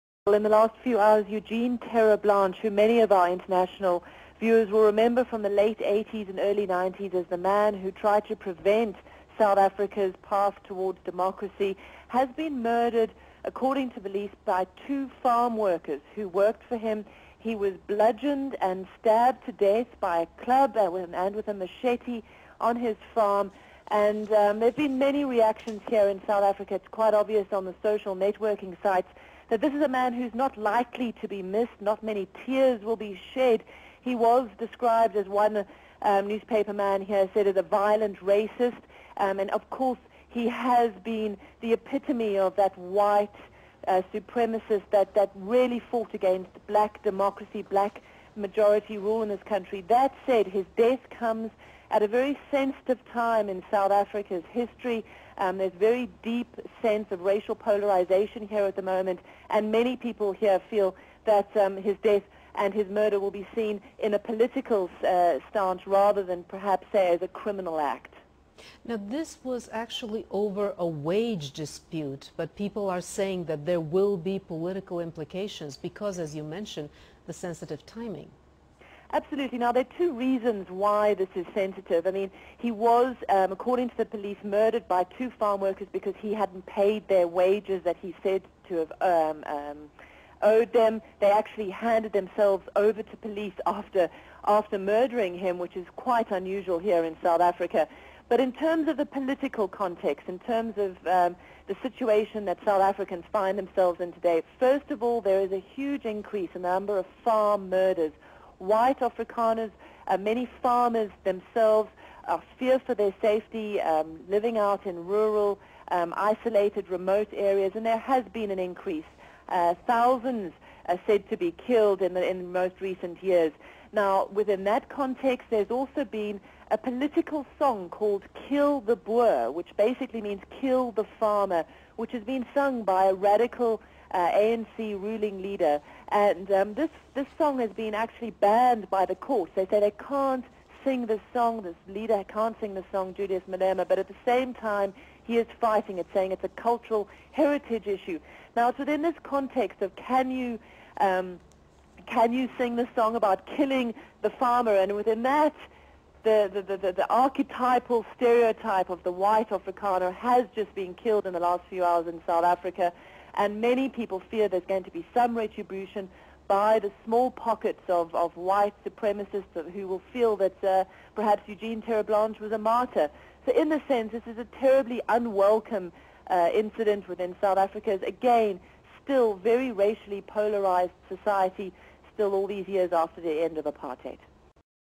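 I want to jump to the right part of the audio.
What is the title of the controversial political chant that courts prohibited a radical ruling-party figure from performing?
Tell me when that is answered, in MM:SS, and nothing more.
02:08.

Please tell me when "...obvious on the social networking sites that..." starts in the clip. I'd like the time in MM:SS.
00:27.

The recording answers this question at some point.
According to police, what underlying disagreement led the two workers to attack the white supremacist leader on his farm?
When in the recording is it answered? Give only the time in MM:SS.
01:10.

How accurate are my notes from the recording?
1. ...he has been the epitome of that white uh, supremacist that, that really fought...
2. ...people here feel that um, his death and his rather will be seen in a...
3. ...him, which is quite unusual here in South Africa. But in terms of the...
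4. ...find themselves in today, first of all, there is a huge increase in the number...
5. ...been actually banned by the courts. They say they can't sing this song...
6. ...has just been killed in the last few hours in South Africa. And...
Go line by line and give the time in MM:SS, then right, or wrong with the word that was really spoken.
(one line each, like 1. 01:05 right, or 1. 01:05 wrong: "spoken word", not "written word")
1. 00:40 right
2. 00:59 wrong: "murder", not "rather"
3. 01:35 right
4. 01:43 right
5. 02:17 right
6. 02:40 right.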